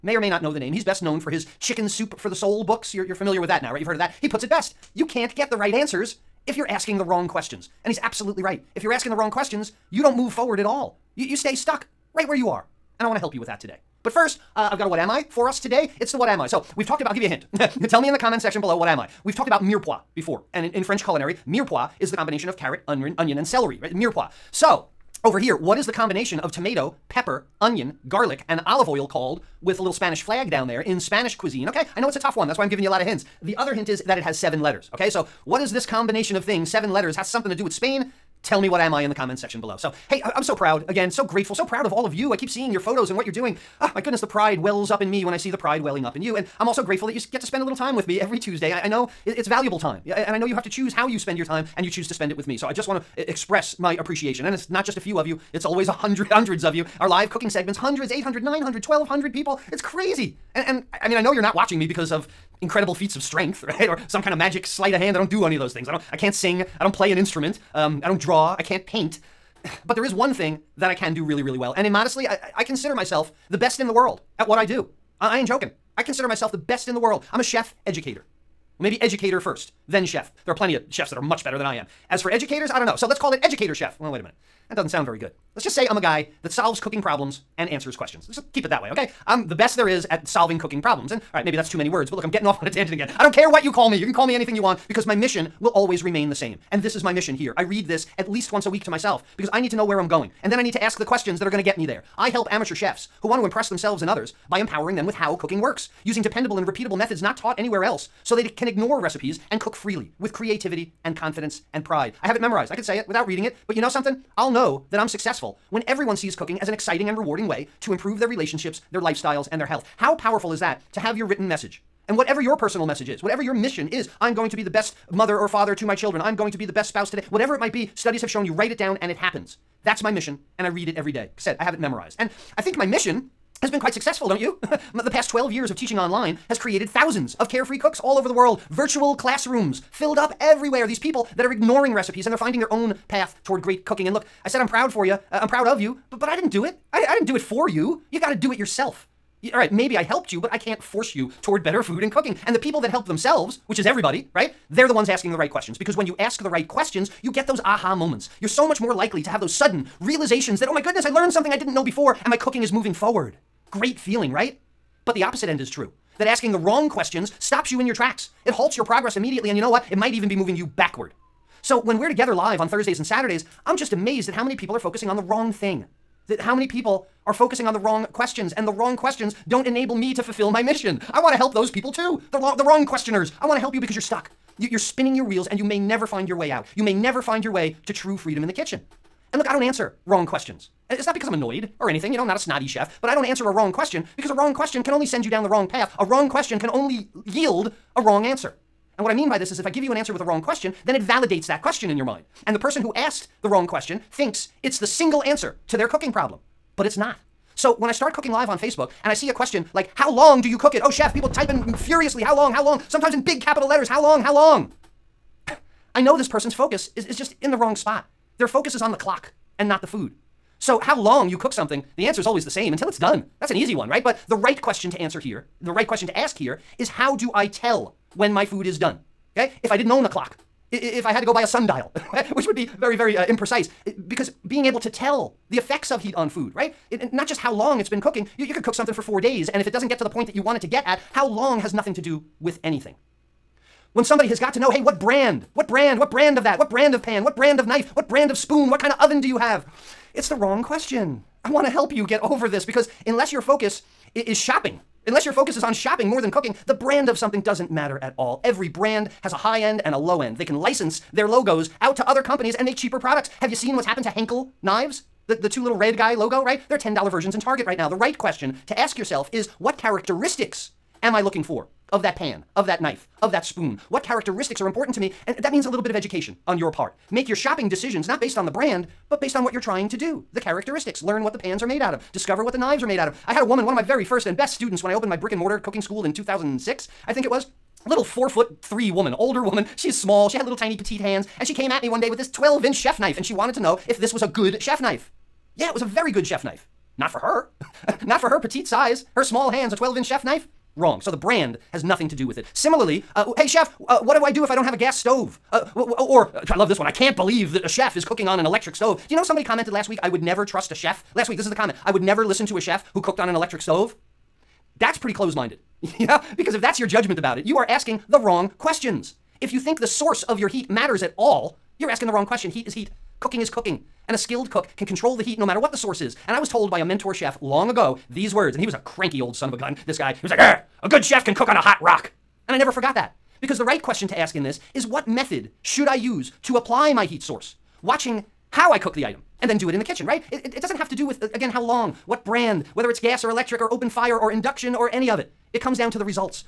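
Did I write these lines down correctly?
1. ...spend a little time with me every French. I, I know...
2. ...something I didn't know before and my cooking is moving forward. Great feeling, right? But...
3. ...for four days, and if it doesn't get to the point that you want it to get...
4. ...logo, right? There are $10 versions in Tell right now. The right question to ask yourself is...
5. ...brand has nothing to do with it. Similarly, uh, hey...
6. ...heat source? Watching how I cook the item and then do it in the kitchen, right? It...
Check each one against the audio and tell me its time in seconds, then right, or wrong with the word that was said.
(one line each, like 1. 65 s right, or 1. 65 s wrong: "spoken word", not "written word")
1. 47 s wrong: "Tuesday", not "French"
2. 161 s right
3. 238 s right
4. 266 s wrong: "Target", not "Tell"
5. 301 s right
6. 337 s right.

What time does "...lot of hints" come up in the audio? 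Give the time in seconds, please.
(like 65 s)
32 s.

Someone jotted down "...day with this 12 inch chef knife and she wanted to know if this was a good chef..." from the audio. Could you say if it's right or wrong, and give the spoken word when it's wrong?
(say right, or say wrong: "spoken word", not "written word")
right.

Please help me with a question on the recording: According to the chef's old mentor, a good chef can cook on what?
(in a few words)
a hot rock.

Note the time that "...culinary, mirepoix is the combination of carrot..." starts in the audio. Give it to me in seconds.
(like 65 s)
21 s.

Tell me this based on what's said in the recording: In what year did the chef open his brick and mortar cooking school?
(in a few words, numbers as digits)
2006.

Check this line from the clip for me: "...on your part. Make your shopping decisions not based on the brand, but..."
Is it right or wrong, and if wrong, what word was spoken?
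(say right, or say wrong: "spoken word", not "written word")
right.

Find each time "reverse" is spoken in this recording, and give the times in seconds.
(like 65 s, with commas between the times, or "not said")
not said.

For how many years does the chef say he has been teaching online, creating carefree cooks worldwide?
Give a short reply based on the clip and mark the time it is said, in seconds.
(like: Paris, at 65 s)
12, at 135 s.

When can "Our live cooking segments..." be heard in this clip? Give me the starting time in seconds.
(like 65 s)
56 s.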